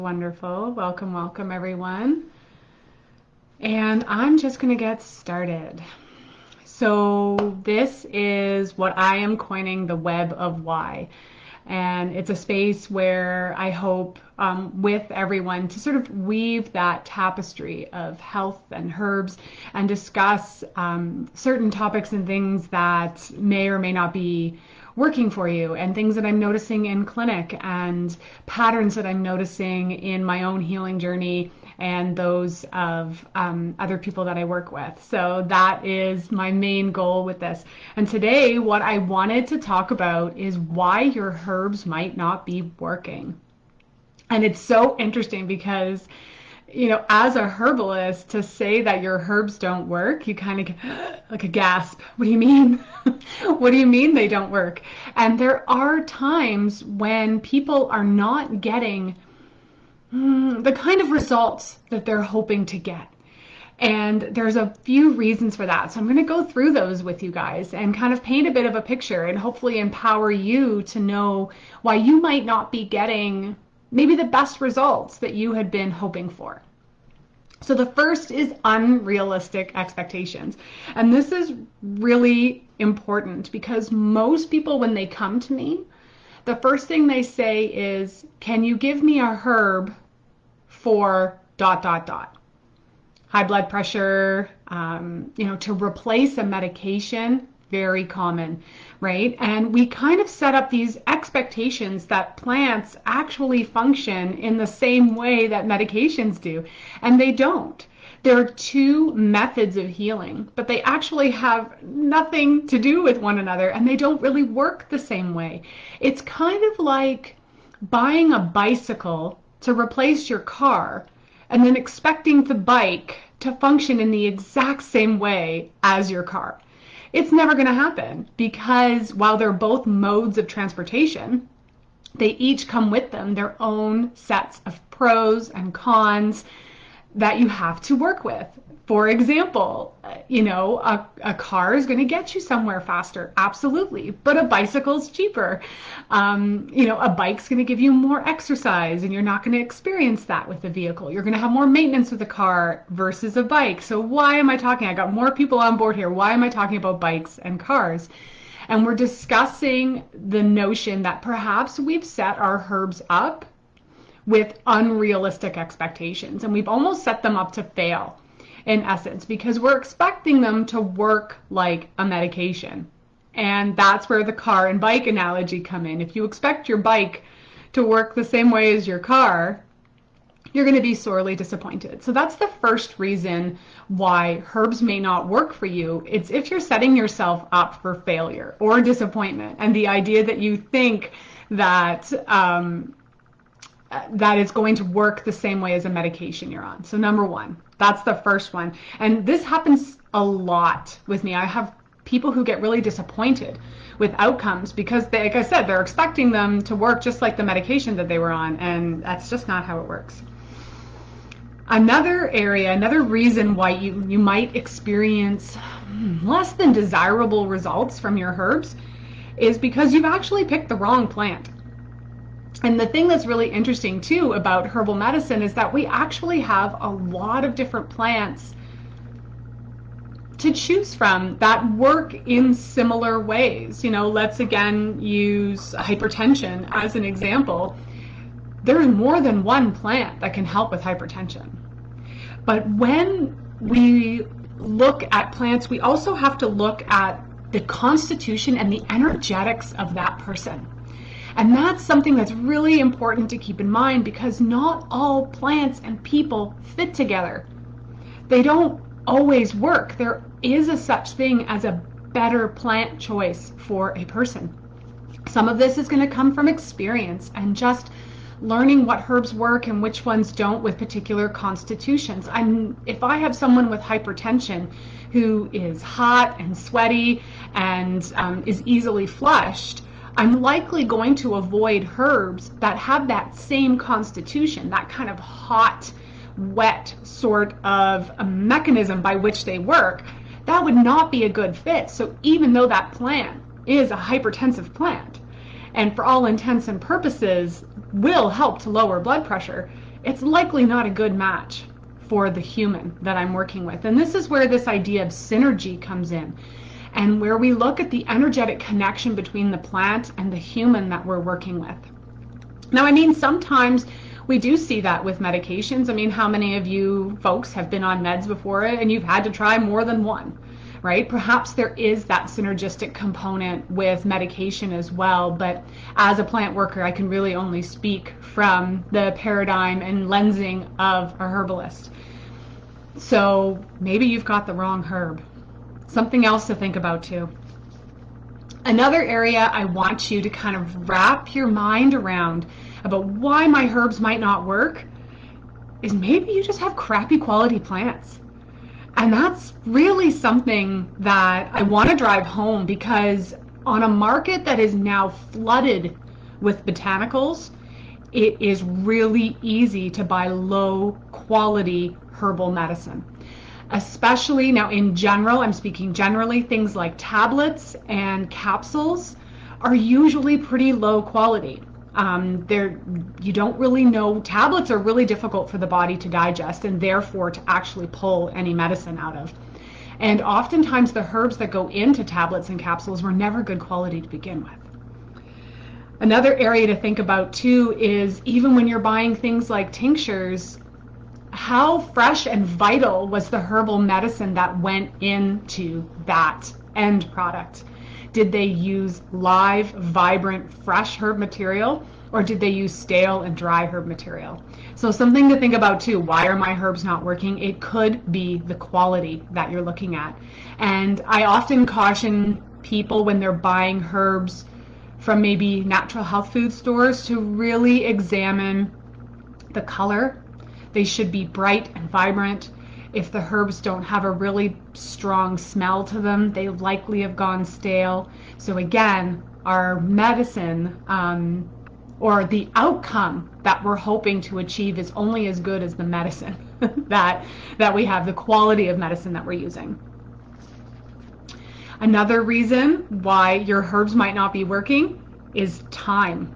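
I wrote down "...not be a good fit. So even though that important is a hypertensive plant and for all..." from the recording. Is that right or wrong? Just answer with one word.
wrong.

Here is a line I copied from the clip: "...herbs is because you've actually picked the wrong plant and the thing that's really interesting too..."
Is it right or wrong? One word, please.
right.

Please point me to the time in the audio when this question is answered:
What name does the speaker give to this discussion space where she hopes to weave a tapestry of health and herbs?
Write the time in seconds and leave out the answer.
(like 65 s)
9 s.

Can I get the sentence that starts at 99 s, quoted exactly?
And we kind of set up these expectations that plants actually function in the same way that medications do, and they don't.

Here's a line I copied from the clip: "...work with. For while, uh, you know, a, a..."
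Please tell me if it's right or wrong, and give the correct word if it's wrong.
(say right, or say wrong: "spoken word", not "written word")
wrong: "example", not "while".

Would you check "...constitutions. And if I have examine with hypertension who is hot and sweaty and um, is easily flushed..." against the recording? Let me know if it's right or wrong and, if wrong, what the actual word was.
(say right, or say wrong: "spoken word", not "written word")
wrong: "someone", not "examine".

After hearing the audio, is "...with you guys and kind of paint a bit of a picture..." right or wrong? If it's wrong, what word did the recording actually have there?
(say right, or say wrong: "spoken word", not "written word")
right.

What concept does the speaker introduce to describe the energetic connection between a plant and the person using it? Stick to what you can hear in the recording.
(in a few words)
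Synergy.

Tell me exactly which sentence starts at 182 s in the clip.
So that's the first reason why herbs may not work for you.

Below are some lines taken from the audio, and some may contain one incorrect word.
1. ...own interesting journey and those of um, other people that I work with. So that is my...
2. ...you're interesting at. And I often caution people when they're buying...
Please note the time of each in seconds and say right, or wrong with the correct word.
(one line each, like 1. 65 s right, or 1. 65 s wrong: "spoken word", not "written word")
1. 30 s wrong: "healing", not "interesting"
2. 409 s wrong: "looking", not "interesting".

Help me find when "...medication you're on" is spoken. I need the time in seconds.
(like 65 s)
195 s.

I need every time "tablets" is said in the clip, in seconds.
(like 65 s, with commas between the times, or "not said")
366 s, 374 s, 382 s.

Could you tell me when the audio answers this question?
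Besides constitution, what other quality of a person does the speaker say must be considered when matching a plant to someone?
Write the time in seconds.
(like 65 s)
248 s.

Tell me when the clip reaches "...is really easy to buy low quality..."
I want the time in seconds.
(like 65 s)
358 s.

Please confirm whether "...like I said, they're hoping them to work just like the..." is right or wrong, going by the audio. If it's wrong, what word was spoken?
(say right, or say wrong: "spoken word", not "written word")
wrong: "expecting", not "hoping".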